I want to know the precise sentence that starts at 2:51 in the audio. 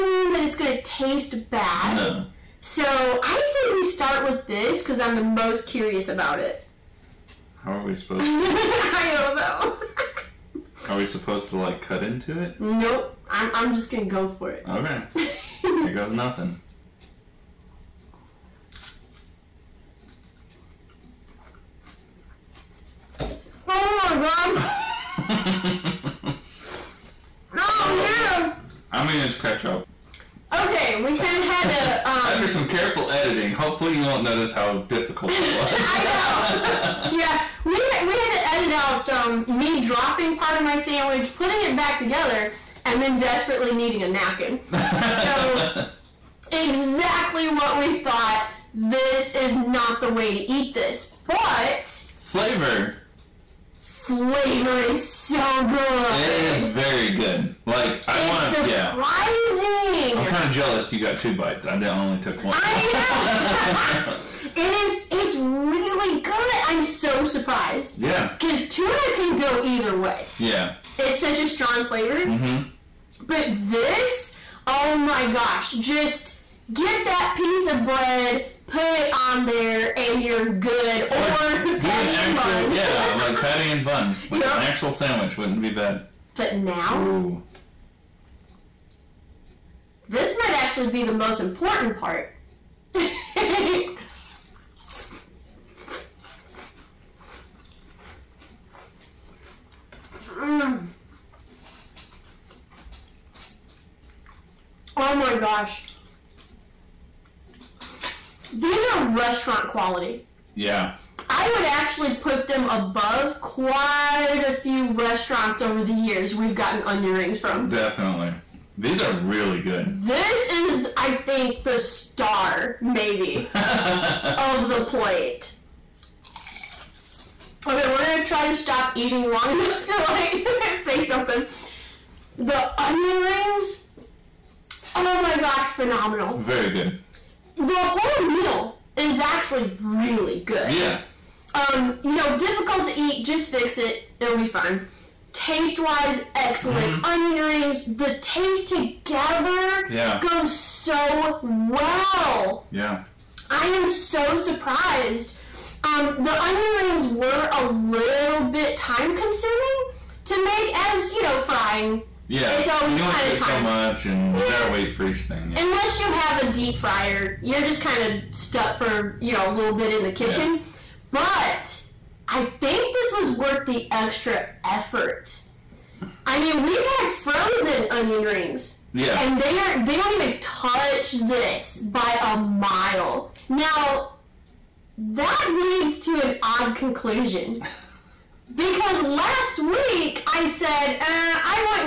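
But I think this was worth the extra effort.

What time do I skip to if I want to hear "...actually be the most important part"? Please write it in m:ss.
1:30.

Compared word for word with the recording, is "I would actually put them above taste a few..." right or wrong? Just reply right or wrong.
wrong.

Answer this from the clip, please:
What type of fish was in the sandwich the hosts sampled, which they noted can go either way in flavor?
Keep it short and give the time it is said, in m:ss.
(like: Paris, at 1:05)
Tuna, at 1:08.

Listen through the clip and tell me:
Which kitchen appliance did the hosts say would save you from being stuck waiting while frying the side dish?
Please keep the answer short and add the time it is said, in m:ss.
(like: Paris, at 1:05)
Deep fryer, at 2:46.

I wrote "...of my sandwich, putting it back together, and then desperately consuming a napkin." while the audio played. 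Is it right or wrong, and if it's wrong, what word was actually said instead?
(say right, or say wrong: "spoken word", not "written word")
wrong: "needing", not "consuming".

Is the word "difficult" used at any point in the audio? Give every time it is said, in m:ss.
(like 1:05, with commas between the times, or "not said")
0:34, 2:22.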